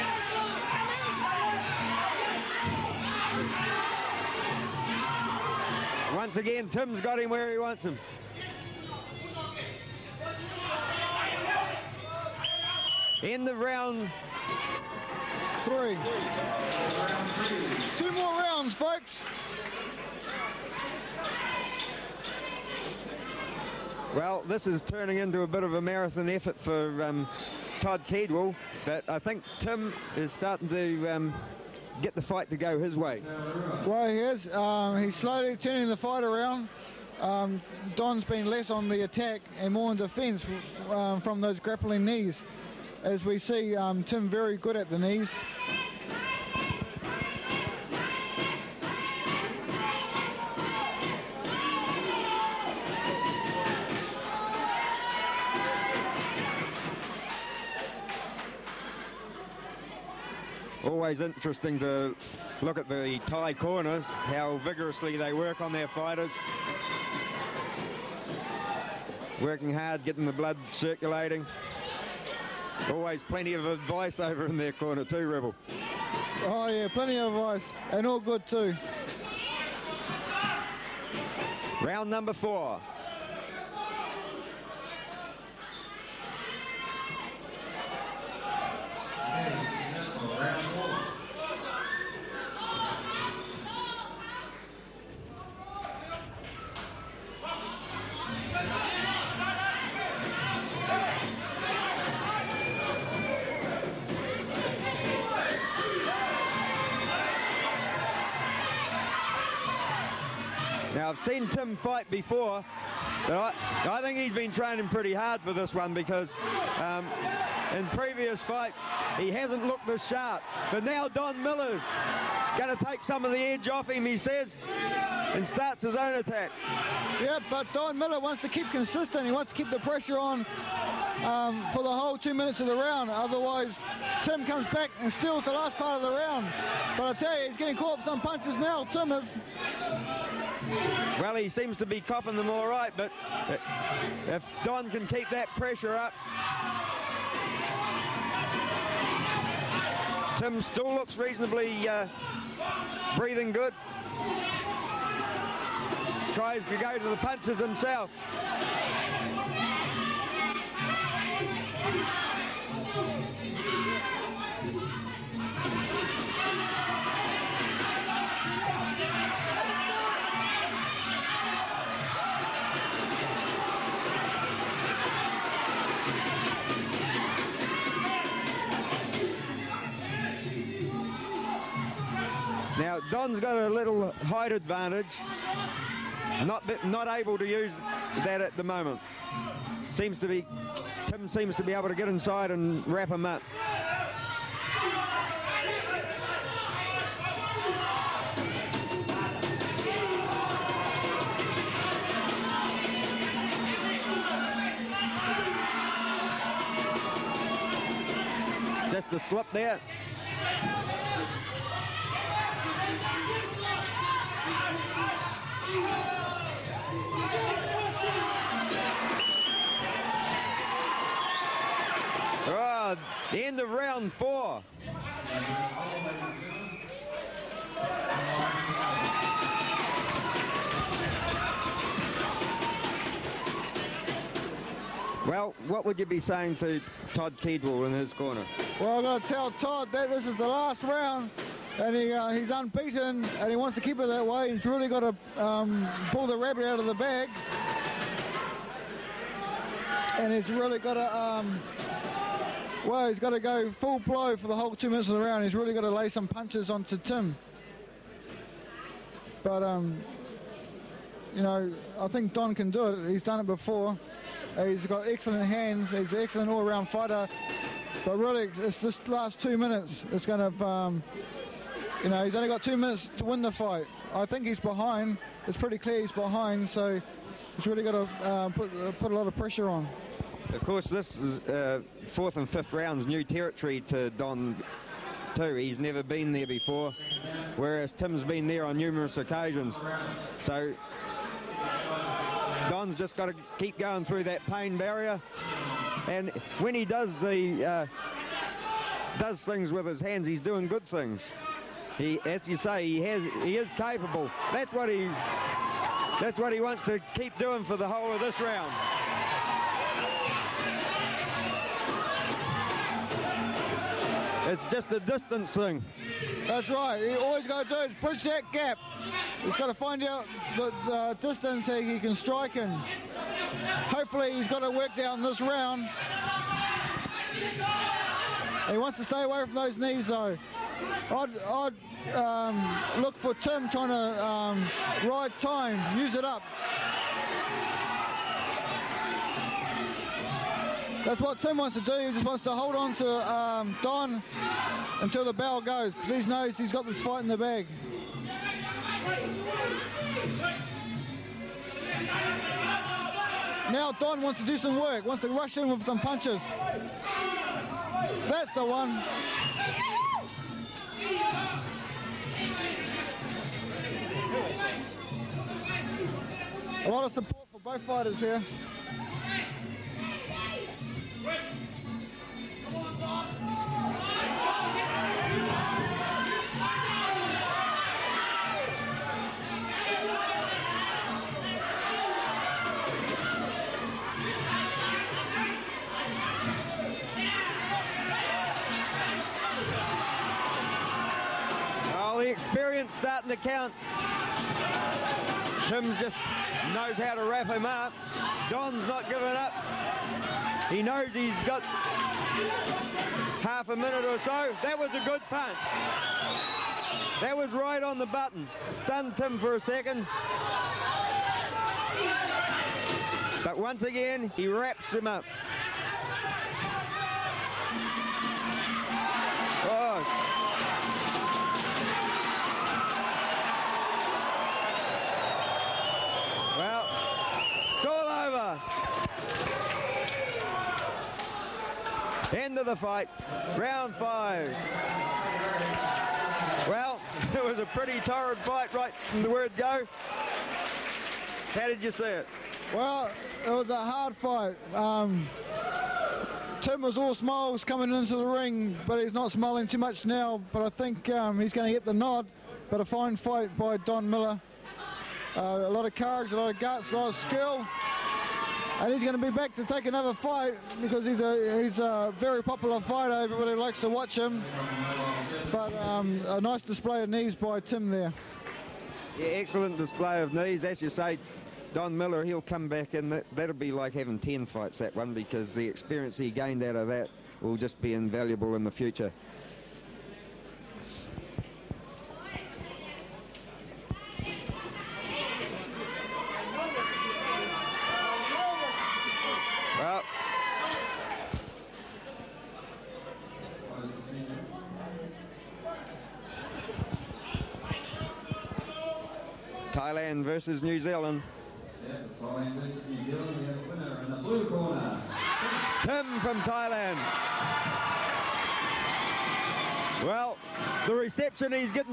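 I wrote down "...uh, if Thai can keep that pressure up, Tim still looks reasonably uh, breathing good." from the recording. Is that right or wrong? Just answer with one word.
wrong.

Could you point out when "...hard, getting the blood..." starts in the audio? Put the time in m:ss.
1:09.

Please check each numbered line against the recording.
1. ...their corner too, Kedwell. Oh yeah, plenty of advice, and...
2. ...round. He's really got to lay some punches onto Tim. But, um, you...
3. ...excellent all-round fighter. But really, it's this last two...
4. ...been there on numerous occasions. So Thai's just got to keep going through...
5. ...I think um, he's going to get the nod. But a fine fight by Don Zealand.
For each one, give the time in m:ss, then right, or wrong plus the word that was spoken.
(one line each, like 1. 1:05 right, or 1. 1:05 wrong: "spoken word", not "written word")
1. 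1:14 wrong: "Rebel", not "Kedwell"
2. 4:15 right
3. 4:26 right
4. 4:48 wrong: "Don", not "Thai"
5. 7:30 wrong: "Millar", not "Zealand".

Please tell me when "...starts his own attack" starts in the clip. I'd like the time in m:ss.
2:05.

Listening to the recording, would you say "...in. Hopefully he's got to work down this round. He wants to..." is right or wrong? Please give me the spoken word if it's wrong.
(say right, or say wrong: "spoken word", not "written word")
right.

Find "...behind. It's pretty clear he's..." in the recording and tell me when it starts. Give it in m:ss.
4:34.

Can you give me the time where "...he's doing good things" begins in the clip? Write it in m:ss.
5:00.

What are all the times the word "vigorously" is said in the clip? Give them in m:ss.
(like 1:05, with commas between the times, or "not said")
1:04.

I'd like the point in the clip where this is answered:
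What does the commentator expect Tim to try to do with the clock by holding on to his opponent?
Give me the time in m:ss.
5:35.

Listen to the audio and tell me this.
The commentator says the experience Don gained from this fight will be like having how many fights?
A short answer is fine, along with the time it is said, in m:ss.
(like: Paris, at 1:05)
10, at 7:54.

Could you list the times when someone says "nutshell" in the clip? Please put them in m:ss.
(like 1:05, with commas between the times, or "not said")
not said.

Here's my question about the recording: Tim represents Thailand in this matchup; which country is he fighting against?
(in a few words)
New Zealand.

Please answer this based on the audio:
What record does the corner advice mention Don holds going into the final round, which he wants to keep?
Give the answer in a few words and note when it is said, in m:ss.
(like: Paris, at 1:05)
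Unbeaten, at 4:02.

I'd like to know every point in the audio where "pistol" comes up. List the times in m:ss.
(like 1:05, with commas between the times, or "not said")
not said.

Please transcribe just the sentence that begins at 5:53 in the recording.
Now Don wants to do some work, wants to rush in with some punches.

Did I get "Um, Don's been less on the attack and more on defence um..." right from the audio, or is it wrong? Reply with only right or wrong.
right.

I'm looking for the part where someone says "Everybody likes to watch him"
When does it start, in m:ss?
7:43.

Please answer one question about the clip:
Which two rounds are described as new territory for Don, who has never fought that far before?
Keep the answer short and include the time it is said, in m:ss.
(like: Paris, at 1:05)
Fourth and fifth, at 4:42.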